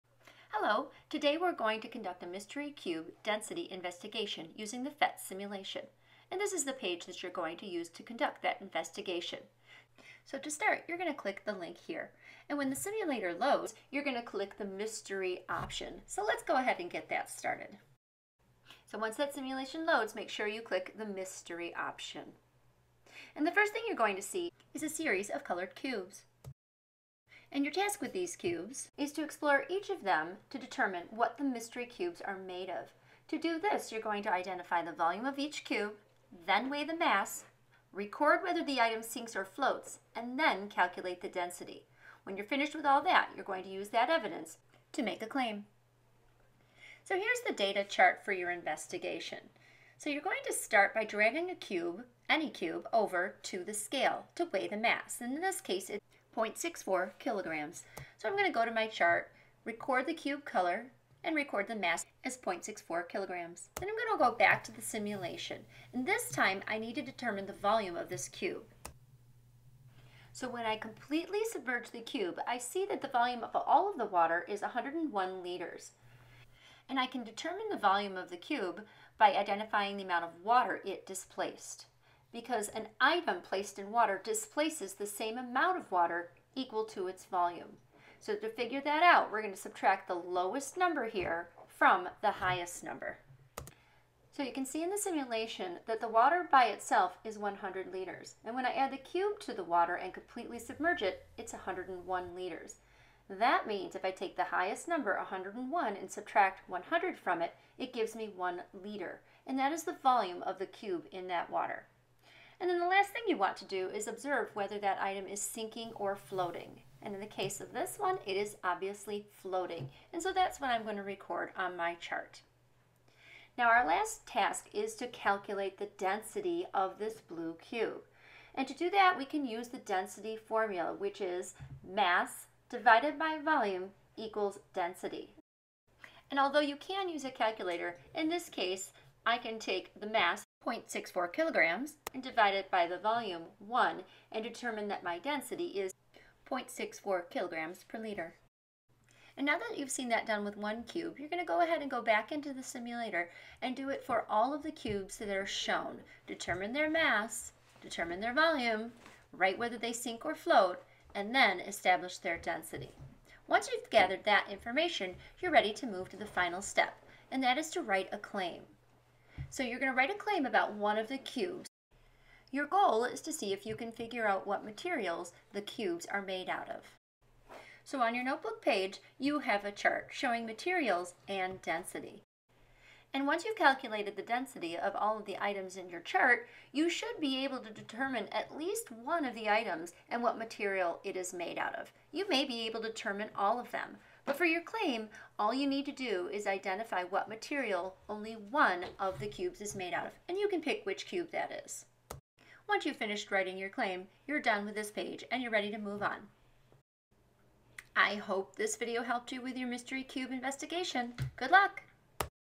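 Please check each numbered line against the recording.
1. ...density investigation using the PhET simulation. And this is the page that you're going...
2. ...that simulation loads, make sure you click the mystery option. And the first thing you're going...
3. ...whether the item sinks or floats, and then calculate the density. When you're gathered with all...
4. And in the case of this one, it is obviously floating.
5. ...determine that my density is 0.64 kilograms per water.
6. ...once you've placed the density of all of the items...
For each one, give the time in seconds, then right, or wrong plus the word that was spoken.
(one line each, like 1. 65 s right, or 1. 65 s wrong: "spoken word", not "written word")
1. 3 s right
2. 19 s right
3. 38 s wrong: "finished", not "gathered"
4. 117 s right
5. 144 s wrong: "liter", not "water"
6. 183 s wrong: "calculated", not "placed".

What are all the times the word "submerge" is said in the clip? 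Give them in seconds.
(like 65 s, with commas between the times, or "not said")
71 s, 100 s.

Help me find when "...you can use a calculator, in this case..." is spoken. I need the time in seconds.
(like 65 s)
136 s.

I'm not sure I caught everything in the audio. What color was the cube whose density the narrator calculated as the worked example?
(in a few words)
blue.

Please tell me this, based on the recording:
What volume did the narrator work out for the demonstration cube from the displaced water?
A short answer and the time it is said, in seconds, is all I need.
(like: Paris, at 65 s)
1 liter, at 108 s.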